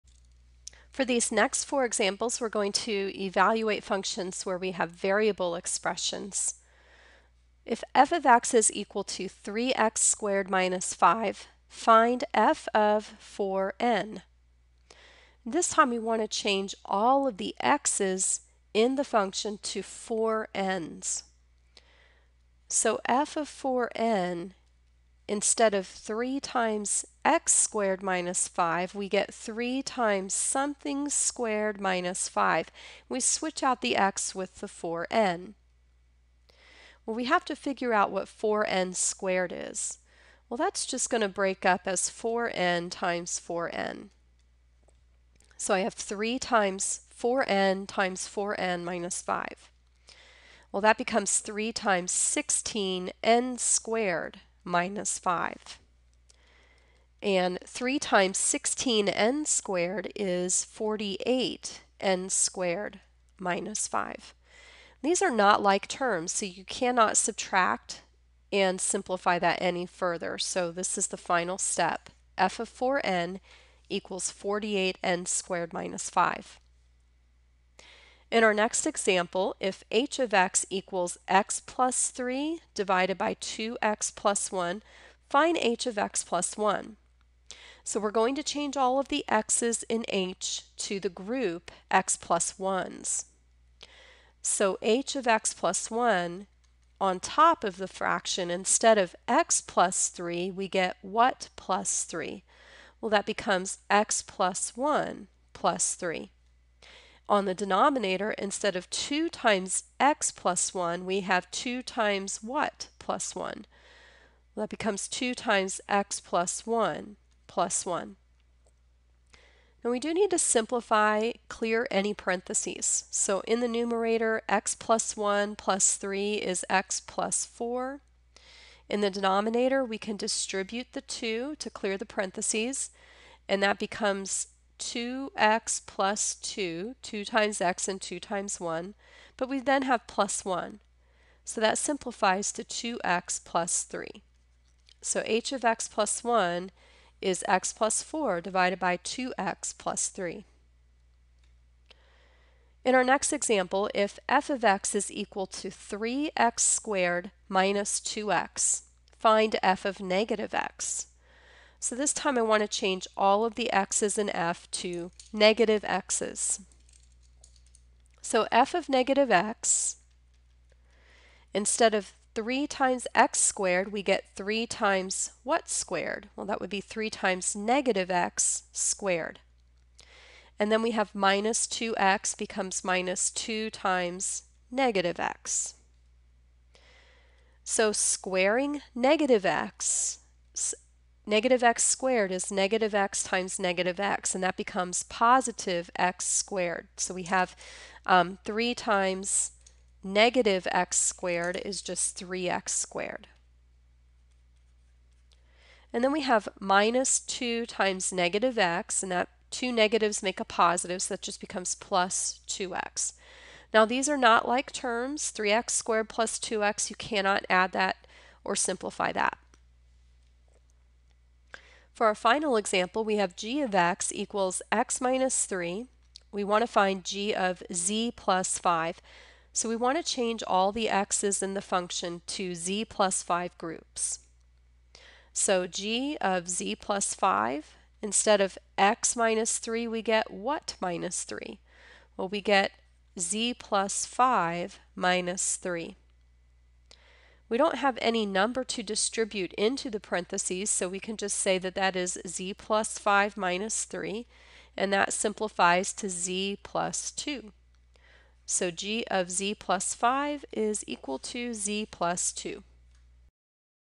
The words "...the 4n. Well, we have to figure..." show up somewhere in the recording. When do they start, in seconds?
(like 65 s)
34 s.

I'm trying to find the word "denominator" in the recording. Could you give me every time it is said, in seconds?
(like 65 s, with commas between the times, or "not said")
107 s, 129 s.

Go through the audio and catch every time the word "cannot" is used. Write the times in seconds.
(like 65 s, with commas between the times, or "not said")
66 s, 216 s.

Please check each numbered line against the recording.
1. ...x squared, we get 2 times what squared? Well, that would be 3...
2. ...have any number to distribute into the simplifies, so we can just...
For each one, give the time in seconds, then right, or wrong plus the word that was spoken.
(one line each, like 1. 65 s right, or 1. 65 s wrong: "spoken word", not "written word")
1. 173 s wrong: "3", not "2"
2. 247 s wrong: "parentheses", not "simplifies".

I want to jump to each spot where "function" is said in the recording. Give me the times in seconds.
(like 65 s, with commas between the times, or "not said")
3 s, 19 s, 231 s.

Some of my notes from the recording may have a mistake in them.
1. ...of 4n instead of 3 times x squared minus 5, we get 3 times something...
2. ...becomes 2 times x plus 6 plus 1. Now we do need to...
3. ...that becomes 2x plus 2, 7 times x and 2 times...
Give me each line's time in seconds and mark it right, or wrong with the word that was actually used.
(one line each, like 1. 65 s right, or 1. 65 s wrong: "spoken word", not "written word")
1. 23 s right
2. 114 s wrong: "1", not "6"
3. 133 s wrong: "2", not "7".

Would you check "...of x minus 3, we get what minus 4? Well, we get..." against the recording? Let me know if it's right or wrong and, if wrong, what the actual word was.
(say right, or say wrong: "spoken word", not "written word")
wrong: "3", not "4".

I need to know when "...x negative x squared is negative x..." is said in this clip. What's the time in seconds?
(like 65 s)
189 s.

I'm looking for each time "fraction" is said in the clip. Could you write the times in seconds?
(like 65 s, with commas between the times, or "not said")
97 s.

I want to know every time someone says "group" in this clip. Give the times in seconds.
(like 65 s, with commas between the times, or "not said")
91 s, 233 s.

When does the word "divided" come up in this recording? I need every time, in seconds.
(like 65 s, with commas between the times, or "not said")
82 s, 148 s.